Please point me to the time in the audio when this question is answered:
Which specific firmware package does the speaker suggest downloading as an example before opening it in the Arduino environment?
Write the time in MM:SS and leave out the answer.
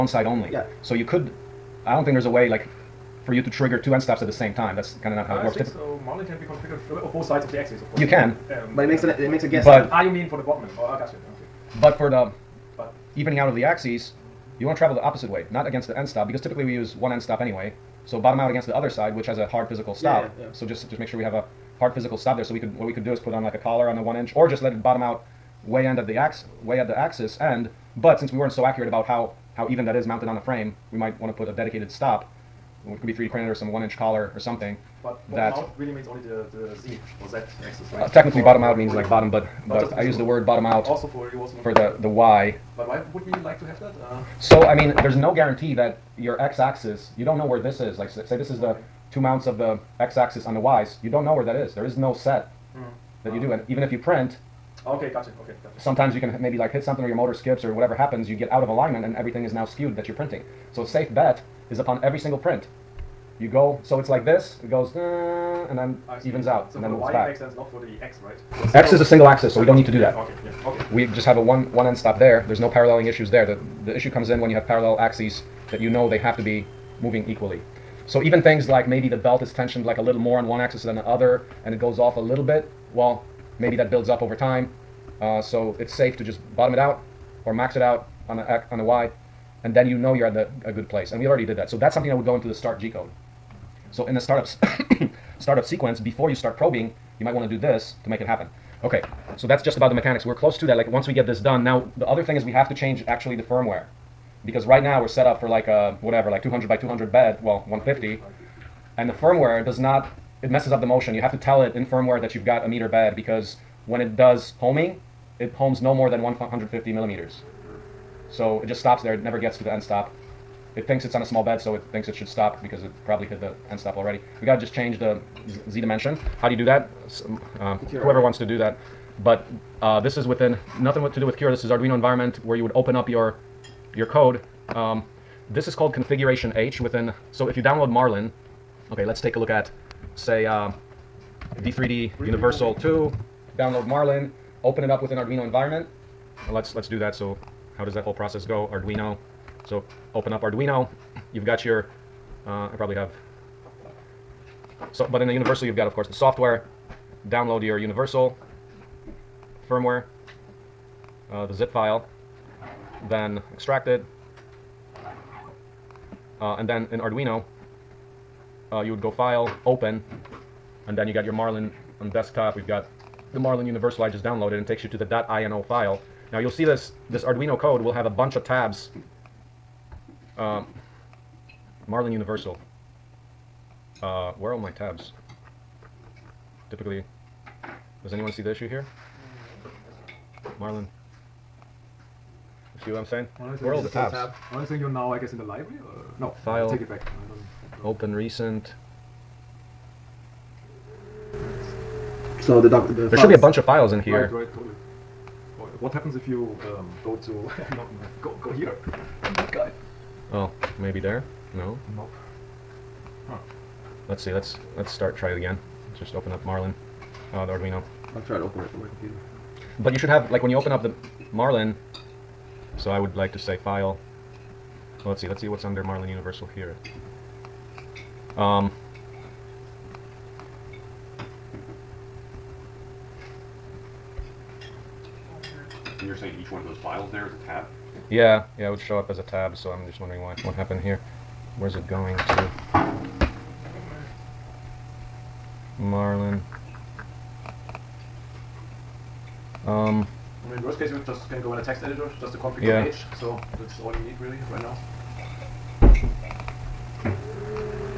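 02:21.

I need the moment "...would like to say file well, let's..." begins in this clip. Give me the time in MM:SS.
03:42.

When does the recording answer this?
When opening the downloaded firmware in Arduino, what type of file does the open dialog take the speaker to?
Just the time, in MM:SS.
02:55.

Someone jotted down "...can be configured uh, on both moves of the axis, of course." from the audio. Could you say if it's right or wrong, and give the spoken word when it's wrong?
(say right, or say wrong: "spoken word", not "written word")
wrong: "sides", not "moves".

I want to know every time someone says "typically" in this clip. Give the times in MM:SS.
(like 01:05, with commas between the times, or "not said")
00:16, 03:06.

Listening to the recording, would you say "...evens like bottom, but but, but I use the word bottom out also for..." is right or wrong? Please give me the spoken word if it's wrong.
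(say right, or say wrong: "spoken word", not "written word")
wrong: "means", not "evens".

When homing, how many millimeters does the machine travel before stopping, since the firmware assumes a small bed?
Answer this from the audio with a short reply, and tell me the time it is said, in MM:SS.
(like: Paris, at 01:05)
150, at 01:56.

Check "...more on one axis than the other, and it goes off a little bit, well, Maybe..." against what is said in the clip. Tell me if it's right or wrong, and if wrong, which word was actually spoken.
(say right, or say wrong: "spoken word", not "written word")
right.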